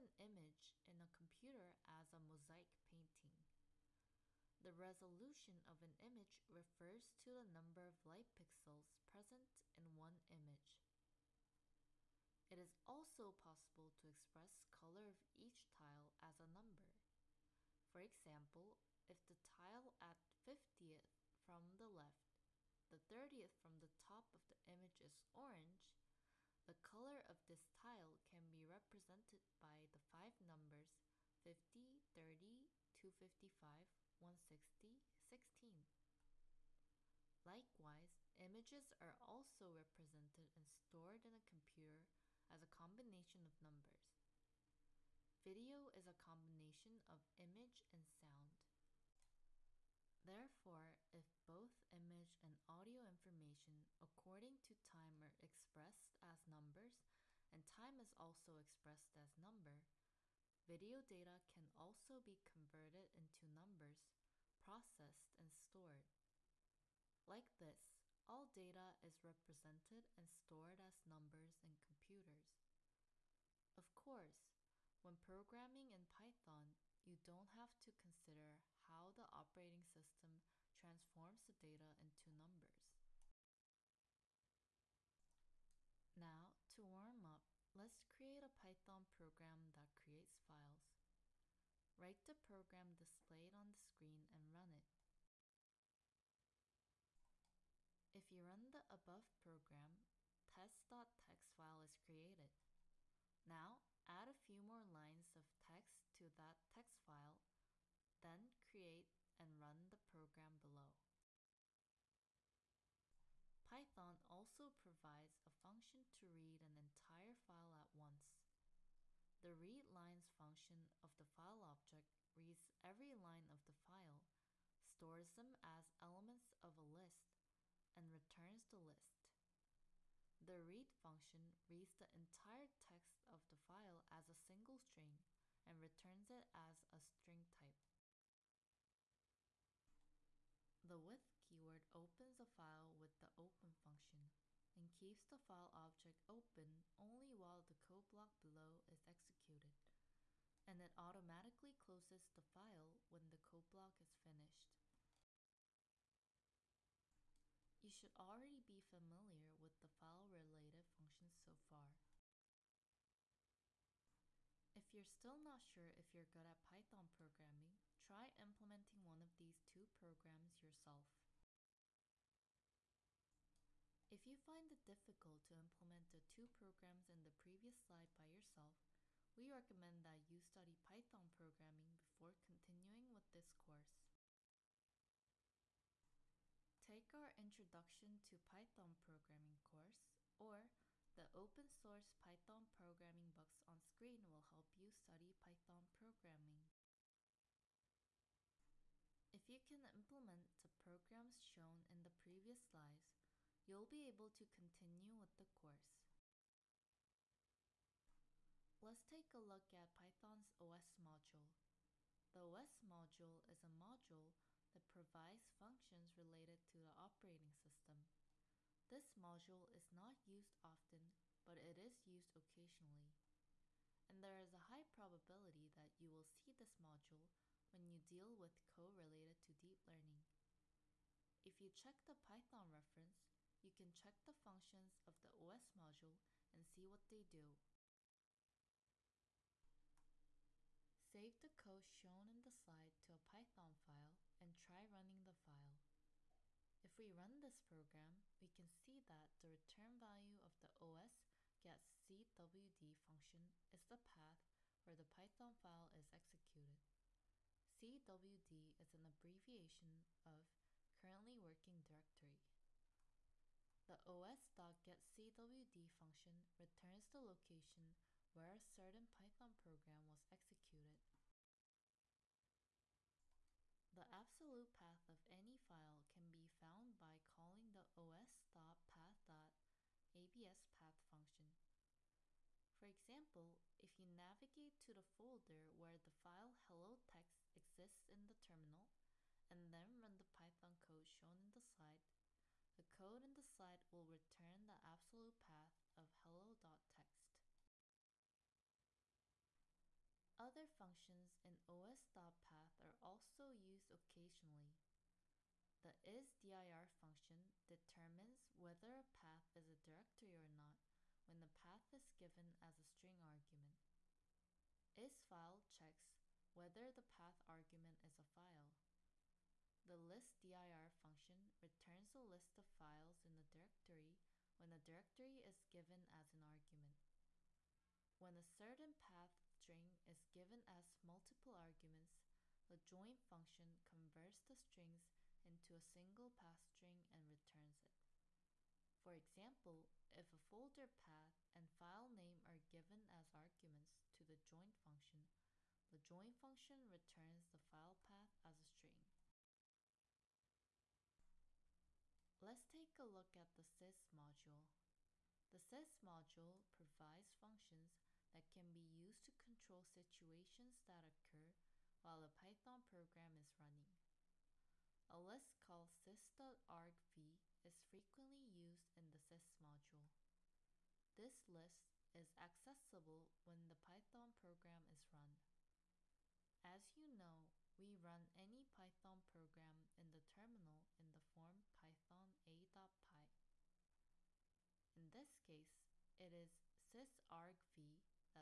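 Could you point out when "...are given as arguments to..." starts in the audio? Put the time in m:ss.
5:42.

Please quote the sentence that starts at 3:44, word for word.
And there is a high probability that you will see this module when you deal with code related to deep learning.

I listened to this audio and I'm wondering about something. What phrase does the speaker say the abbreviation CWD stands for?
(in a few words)
currently working directory.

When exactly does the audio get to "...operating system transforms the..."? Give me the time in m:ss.
1:19.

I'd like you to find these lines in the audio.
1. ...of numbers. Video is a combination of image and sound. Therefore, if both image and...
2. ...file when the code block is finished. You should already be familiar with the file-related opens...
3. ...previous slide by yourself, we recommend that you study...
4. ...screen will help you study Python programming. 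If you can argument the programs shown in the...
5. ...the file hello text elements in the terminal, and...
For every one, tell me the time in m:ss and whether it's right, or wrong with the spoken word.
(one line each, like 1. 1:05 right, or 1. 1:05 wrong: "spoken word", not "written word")
1. 0:43 right
2. 2:32 wrong: "functions", not "opens"
3. 2:57 right
4. 3:13 wrong: "implement", not "argument"
5. 4:45 wrong: "exists", not "elements".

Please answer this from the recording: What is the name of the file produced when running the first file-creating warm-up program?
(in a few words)
test.txt.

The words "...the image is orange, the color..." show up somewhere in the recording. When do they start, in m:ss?
0:24.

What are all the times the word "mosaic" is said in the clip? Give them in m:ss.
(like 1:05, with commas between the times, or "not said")
0:02.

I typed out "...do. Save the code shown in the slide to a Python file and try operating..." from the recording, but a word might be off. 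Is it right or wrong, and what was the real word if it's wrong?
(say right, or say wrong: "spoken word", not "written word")
wrong: "running", not "operating".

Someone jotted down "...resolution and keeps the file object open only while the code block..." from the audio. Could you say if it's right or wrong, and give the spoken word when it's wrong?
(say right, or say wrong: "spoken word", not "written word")
wrong: "function", not "resolution".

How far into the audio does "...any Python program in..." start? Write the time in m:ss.
6:18.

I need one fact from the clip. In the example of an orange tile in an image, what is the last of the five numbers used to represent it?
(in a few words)
16.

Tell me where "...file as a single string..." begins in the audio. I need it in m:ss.
2:13.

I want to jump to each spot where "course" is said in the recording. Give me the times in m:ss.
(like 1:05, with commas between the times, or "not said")
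1:13, 3:03, 3:09, 3:25.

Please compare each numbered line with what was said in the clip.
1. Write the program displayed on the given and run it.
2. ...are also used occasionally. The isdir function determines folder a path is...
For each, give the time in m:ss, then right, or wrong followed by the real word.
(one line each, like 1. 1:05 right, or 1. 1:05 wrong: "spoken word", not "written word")
1. 1:31 wrong: "screen", not "given"
2. 5:02 wrong: "whether", not "folder".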